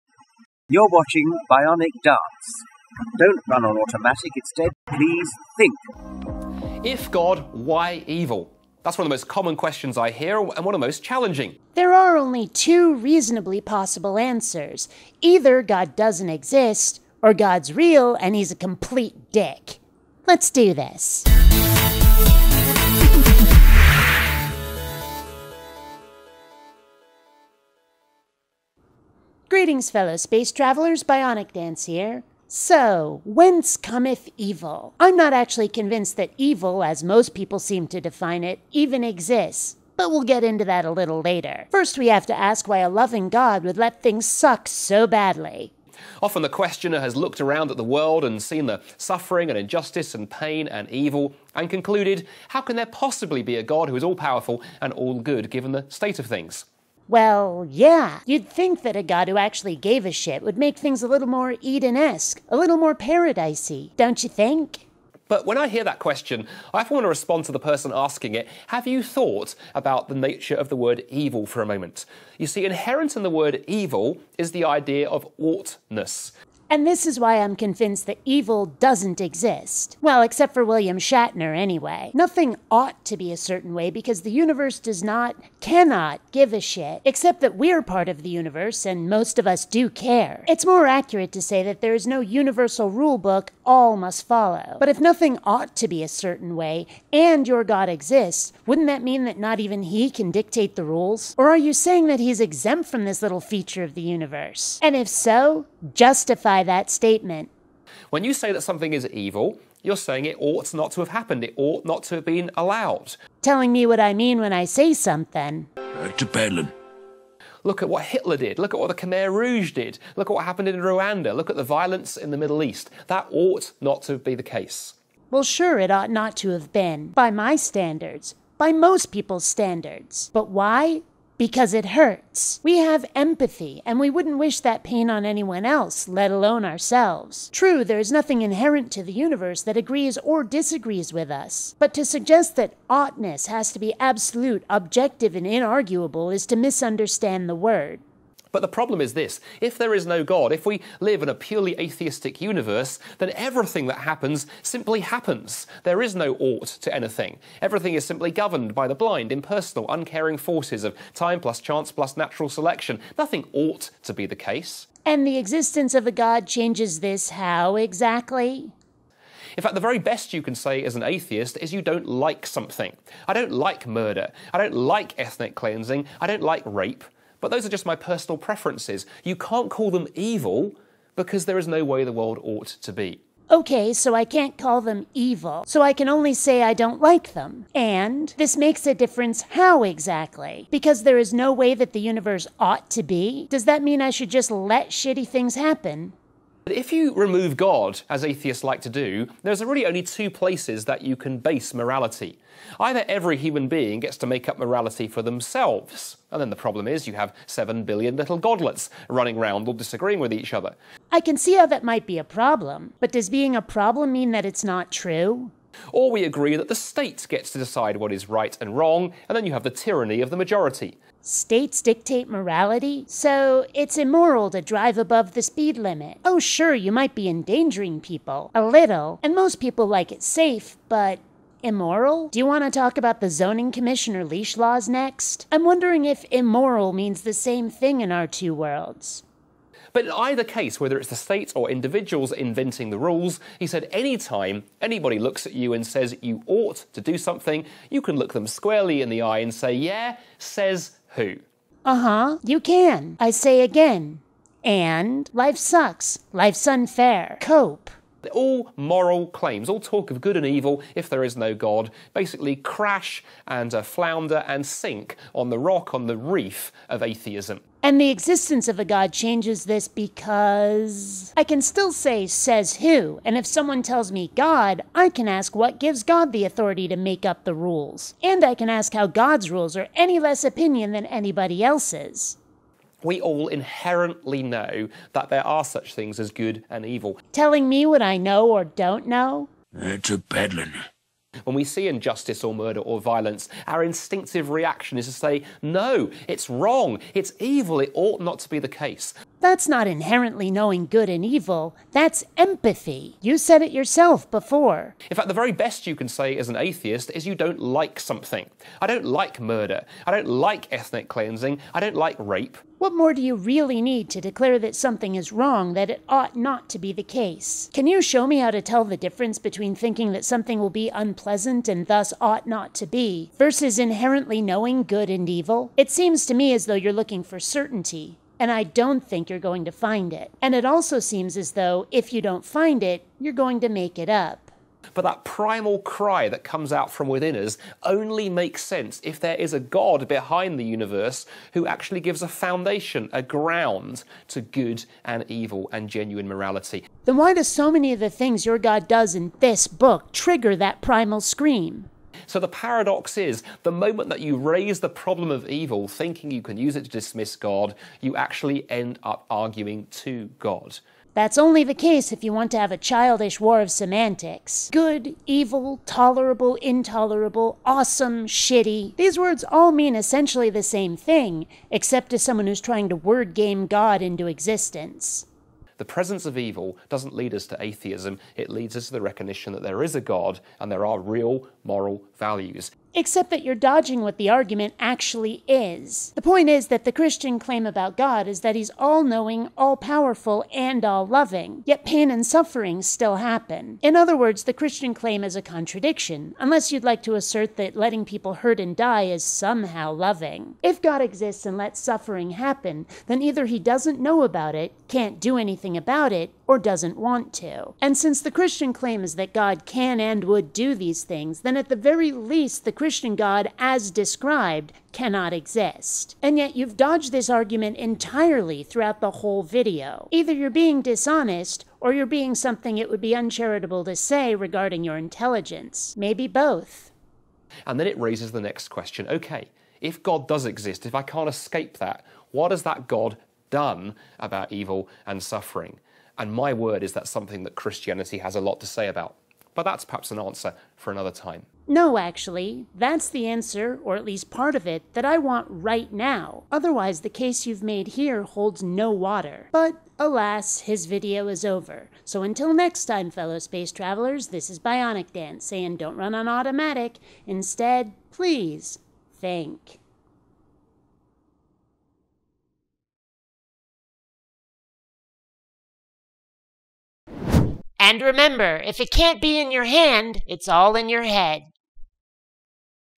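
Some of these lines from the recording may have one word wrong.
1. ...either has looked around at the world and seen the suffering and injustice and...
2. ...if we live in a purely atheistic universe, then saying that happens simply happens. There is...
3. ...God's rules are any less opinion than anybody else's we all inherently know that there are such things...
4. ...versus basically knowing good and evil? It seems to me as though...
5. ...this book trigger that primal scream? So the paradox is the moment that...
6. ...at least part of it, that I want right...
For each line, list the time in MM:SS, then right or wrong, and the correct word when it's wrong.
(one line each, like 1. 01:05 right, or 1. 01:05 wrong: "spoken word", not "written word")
1. 00:46 wrong: "questioner", not "either"
2. 02:30 wrong: "everything", not "saying"
3. 04:39 right
4. 05:23 wrong: "inherently", not "basically"
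5. 05:49 right
6. 07:23 right.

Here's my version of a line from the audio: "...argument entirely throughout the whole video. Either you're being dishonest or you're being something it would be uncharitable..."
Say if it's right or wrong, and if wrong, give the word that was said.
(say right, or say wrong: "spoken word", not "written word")
right.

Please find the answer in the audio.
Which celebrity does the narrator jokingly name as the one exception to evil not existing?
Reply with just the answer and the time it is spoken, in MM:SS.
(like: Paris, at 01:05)
William Shatner, at 01:20.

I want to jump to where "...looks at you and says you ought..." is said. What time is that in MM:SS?
04:05.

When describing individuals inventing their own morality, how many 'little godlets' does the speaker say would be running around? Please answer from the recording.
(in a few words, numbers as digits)
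7 billion.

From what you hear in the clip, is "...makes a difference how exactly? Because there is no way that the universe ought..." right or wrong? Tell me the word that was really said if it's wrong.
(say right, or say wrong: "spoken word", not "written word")
right.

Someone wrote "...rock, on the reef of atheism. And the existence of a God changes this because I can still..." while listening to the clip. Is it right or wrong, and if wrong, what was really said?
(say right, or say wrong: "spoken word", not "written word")
right.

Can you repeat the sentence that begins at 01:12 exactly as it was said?
You see, inherent in the word evil is the idea of oughtness.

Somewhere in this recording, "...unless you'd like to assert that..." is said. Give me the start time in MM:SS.
06:36.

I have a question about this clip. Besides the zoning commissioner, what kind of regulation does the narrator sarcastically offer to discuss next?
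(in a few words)
leash laws.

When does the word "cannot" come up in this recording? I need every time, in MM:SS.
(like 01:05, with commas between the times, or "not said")
01:25, 06:54.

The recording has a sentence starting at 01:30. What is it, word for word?
It's more accurate to say that there is no universal rule book all must follow.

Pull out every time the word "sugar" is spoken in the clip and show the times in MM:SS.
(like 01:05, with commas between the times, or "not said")
not said.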